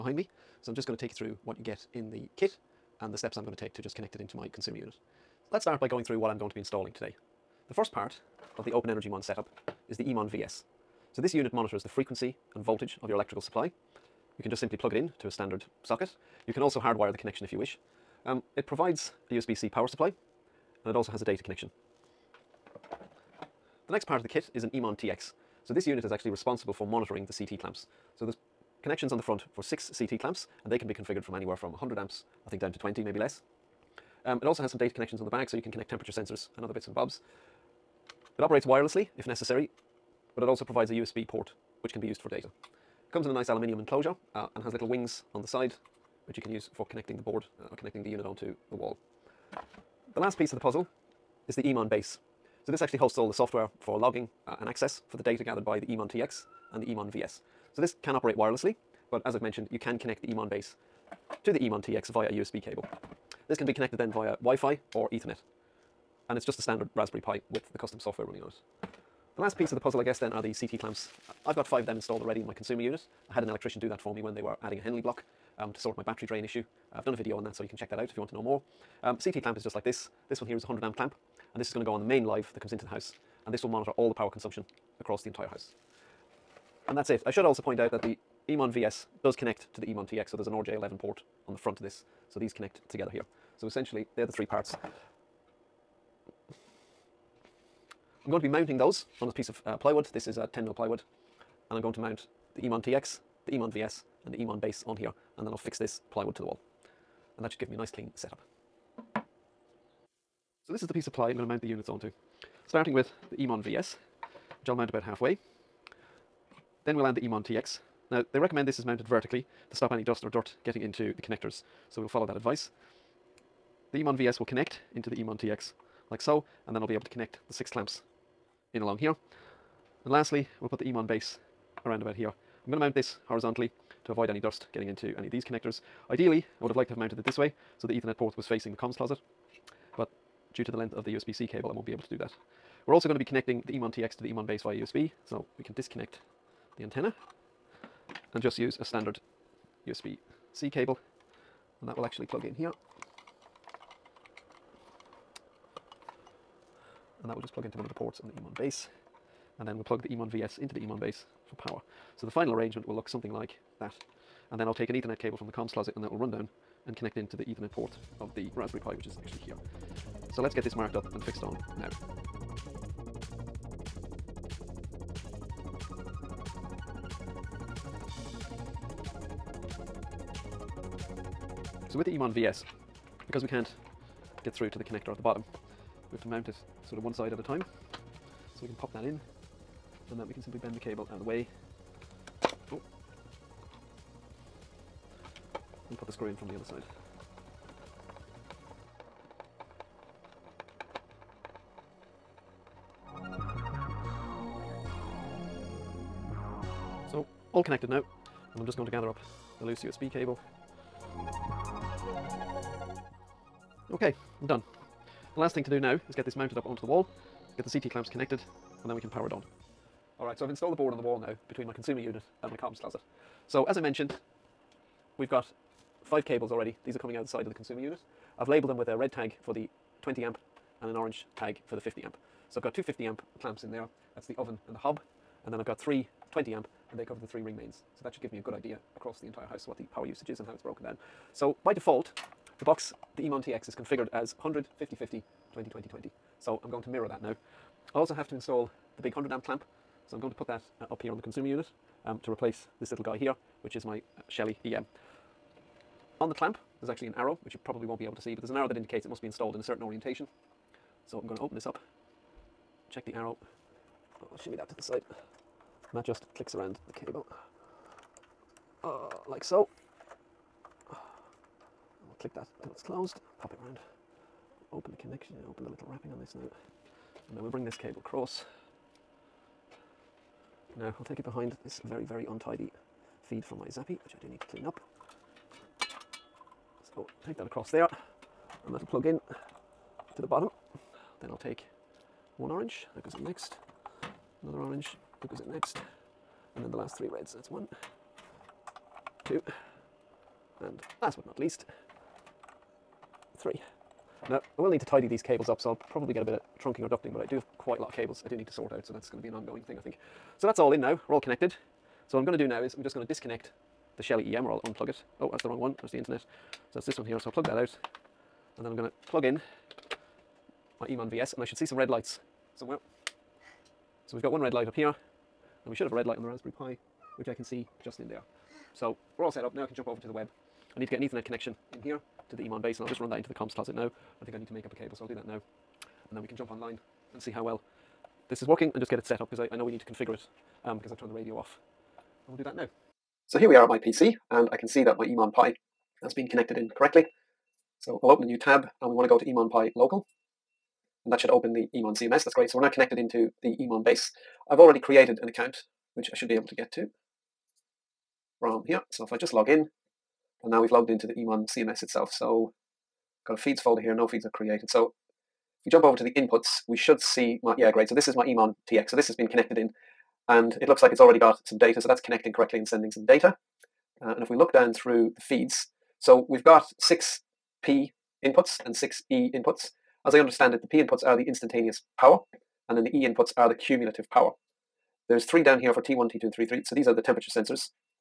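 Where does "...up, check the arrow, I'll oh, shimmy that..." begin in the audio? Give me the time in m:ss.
4:21.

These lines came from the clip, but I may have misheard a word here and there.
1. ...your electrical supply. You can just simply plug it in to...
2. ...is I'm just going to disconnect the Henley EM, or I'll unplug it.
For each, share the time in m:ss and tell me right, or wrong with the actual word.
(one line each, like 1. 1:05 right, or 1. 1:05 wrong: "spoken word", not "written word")
1. 0:13 right
2. 5:12 wrong: "Shelly", not "Henley".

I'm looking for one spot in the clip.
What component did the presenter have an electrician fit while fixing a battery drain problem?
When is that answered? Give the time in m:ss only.
1:14.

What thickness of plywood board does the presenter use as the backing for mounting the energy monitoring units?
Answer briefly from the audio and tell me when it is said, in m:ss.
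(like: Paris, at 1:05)
10 mil, at 1:40.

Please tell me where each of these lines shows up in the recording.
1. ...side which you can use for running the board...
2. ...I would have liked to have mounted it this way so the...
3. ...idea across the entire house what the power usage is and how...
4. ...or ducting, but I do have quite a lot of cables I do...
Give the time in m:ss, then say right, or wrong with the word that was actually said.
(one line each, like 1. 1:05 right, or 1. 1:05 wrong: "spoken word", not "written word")
1. 0:45 wrong: "connecting", not "running"
2. 2:16 right
3. 3:58 right
4. 5:06 right.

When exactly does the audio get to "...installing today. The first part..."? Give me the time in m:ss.
0:06.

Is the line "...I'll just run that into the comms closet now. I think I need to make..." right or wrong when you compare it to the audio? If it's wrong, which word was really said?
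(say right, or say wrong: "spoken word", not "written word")
right.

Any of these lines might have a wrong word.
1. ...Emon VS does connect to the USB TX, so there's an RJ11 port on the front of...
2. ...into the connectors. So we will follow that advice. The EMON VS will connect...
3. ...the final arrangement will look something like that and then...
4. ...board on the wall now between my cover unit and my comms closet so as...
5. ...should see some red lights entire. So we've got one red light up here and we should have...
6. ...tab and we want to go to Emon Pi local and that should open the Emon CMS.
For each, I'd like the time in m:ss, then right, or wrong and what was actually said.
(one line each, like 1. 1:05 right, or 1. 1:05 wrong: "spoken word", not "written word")
1. 1:28 wrong: "Emon", not "USB"
2. 2:00 right
3. 2:42 right
4. 3:40 wrong: "consumer", not "cover"
5. 5:21 wrong: "somewhere", not "entire"
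6. 5:48 right.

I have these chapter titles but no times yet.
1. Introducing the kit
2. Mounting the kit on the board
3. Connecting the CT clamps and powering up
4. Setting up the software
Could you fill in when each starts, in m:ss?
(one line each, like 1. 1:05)
1. 0:05
2. 1:49
3. 3:39
4. 5:42.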